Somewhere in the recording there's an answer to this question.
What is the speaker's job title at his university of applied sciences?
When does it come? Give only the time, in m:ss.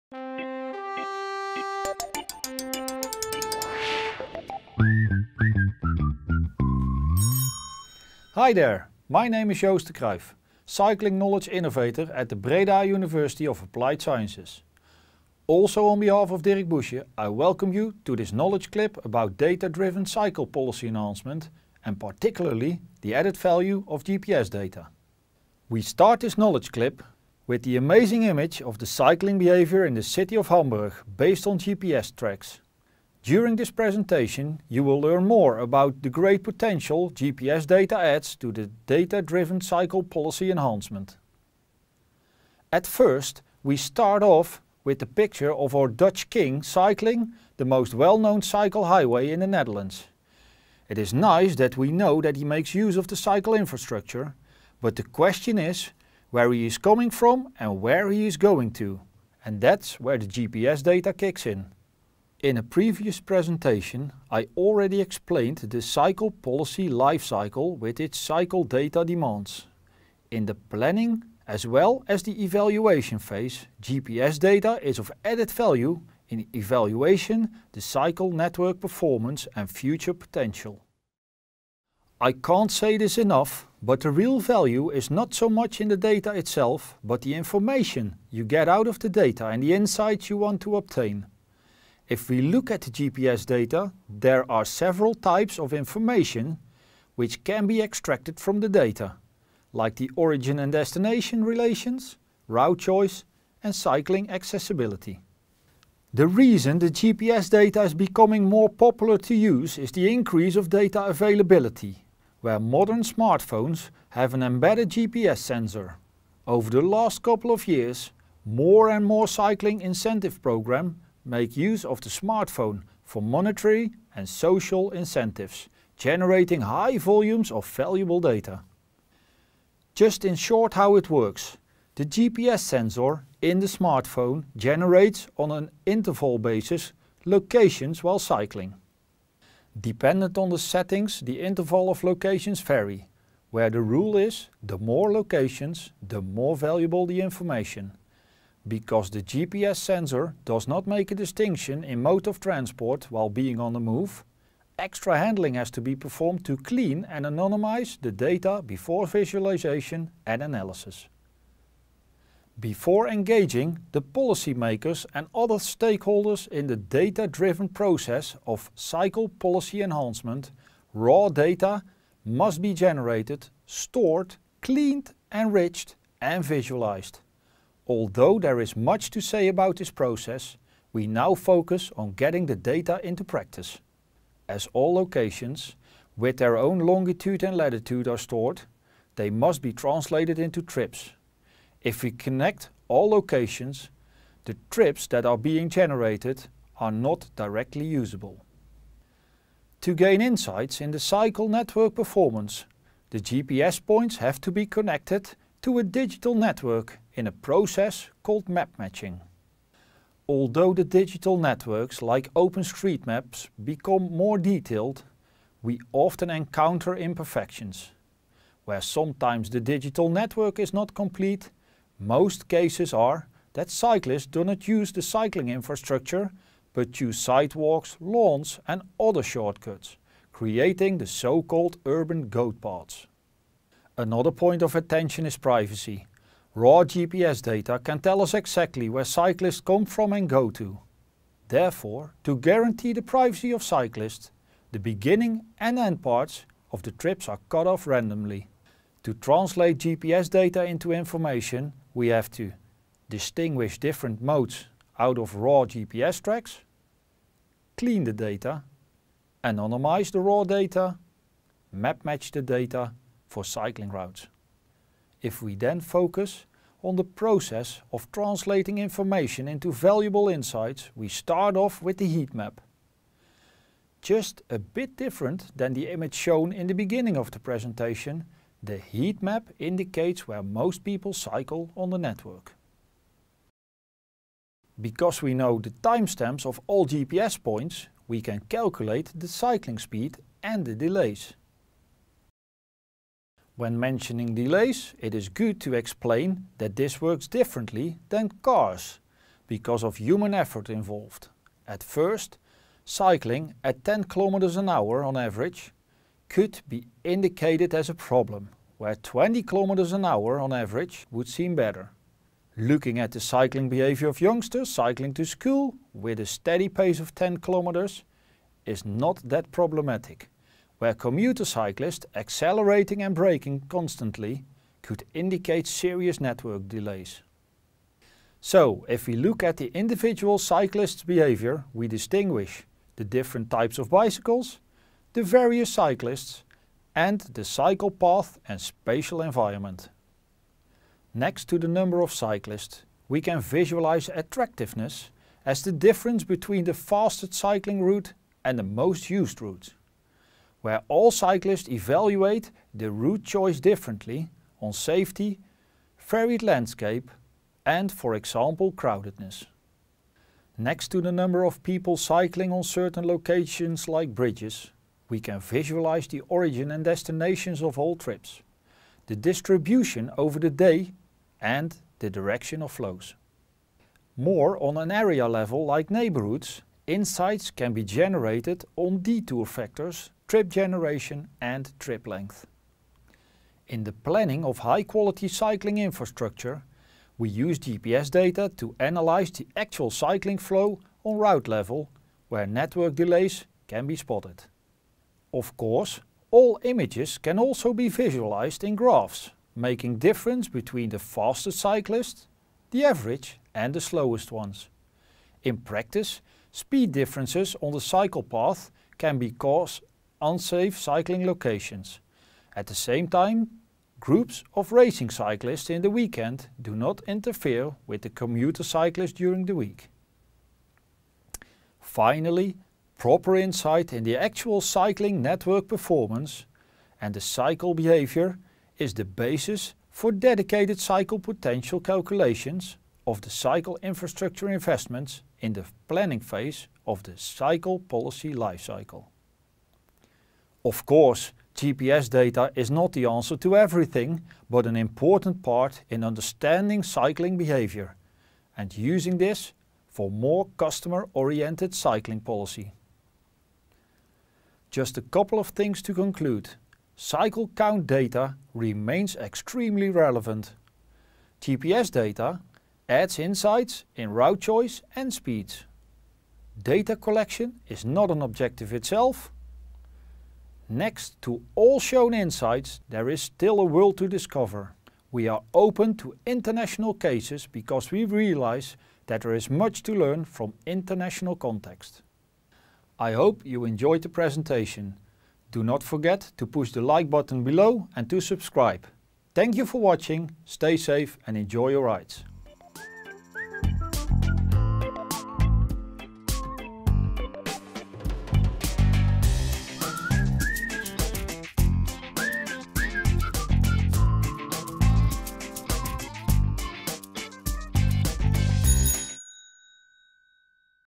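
0:10.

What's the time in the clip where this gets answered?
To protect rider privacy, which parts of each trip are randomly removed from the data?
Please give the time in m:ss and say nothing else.
4:04.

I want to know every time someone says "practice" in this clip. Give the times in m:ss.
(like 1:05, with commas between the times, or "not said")
3:03, 6:45.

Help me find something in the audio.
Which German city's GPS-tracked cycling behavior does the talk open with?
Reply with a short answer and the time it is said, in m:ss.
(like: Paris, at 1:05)
Hamburg, at 0:30.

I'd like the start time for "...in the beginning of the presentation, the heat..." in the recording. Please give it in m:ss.
4:36.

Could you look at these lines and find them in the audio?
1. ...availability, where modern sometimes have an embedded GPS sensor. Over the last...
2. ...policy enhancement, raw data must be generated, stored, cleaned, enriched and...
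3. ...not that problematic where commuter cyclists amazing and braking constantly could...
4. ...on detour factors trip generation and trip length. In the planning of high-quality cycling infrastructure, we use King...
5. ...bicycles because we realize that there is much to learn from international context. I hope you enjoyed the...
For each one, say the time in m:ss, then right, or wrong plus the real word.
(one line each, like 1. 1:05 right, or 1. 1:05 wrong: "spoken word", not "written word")
1. 1:51 wrong: "smartphones", not "sometimes"
2. 2:49 right
3. 5:18 wrong: "accelerating", not "amazing"
4. 6:18 wrong: "GPS", not "King"
5. 7:56 wrong: "cases", not "bicycles".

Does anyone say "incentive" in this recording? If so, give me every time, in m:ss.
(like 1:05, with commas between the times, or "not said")
1:59, 2:04.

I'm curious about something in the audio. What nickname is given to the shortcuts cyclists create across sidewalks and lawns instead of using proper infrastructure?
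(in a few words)
Urban goat paths.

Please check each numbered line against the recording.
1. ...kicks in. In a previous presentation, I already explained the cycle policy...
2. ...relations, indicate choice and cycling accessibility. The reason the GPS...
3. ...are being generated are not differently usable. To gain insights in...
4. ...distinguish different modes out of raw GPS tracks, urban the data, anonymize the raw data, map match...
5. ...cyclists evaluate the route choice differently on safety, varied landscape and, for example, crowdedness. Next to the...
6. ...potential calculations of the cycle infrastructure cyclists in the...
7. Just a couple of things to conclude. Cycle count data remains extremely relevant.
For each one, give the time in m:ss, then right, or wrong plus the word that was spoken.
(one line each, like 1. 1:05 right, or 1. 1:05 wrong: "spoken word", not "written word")
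1. 1:01 right
2. 1:41 wrong: "route", not "indicate"
3. 3:15 wrong: "directly", not "differently"
4. 4:13 wrong: "clean", not "urban"
5. 5:51 right
6. 7:11 wrong: "investments", not "cyclists"
7. 7:34 right.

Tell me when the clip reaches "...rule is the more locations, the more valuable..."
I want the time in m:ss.
2:23.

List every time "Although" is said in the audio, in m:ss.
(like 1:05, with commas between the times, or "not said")
2:57, 3:30.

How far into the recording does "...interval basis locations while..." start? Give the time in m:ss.
2:15.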